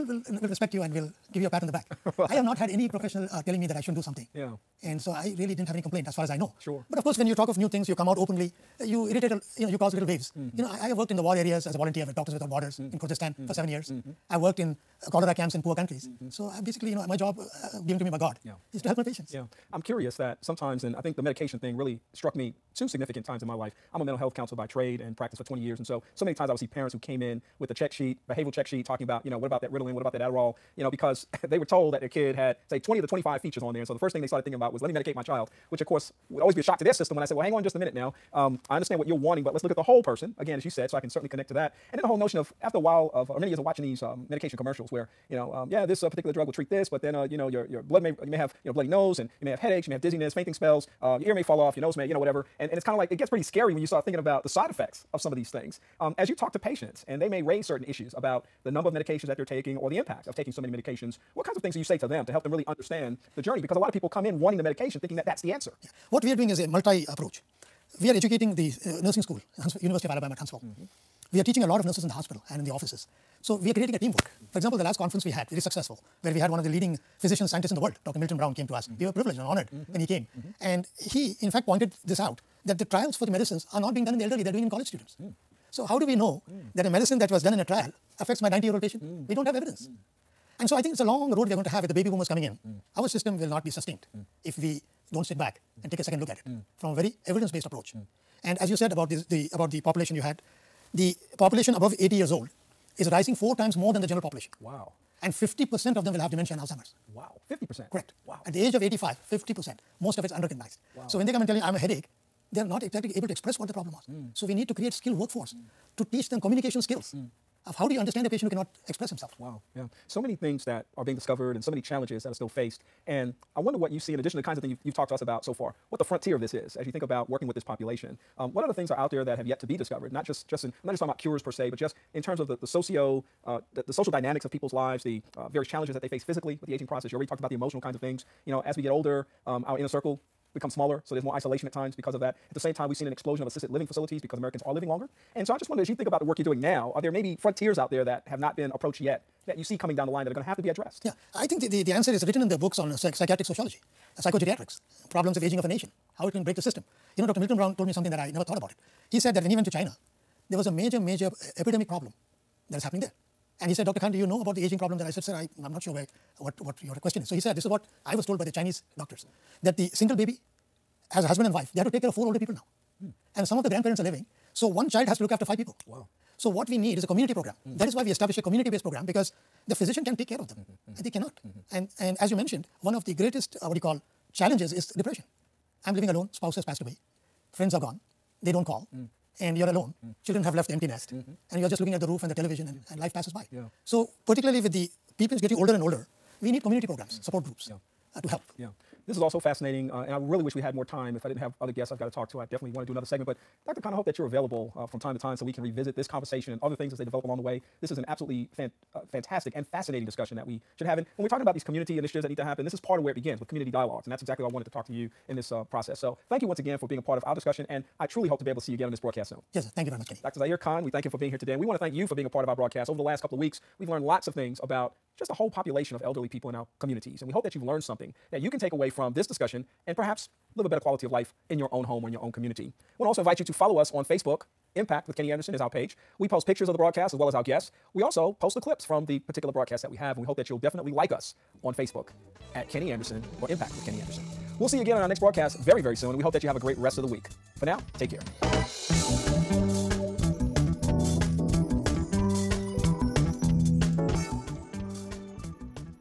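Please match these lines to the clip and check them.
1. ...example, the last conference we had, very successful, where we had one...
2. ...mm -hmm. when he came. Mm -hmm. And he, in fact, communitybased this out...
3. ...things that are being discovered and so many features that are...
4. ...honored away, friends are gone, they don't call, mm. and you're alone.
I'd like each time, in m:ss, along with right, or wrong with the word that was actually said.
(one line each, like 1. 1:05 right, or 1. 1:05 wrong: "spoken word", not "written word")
1. 1:14 right
2. 1:19 wrong: "pointed", not "communitybased"
3. 2:00 wrong: "challenges", not "features"
4. 3:06 wrong: "passed", not "honored".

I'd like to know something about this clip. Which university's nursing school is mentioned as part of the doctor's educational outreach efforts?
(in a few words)
University of Alabama at Huntsville.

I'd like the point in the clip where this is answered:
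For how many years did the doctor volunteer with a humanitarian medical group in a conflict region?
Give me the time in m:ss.
0:13.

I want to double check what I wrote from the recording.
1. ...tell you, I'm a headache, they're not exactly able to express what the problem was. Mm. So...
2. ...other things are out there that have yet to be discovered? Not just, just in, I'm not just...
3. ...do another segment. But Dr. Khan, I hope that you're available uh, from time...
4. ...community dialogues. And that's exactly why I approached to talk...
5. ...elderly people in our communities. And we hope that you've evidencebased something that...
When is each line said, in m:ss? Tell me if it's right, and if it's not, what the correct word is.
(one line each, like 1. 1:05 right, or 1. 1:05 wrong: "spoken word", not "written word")
1. 1:51 right
2. 2:08 right
3. 3:22 right
4. 3:33 wrong: "wanted", not "approached"
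5. 3:46 wrong: "learned", not "evidencebased".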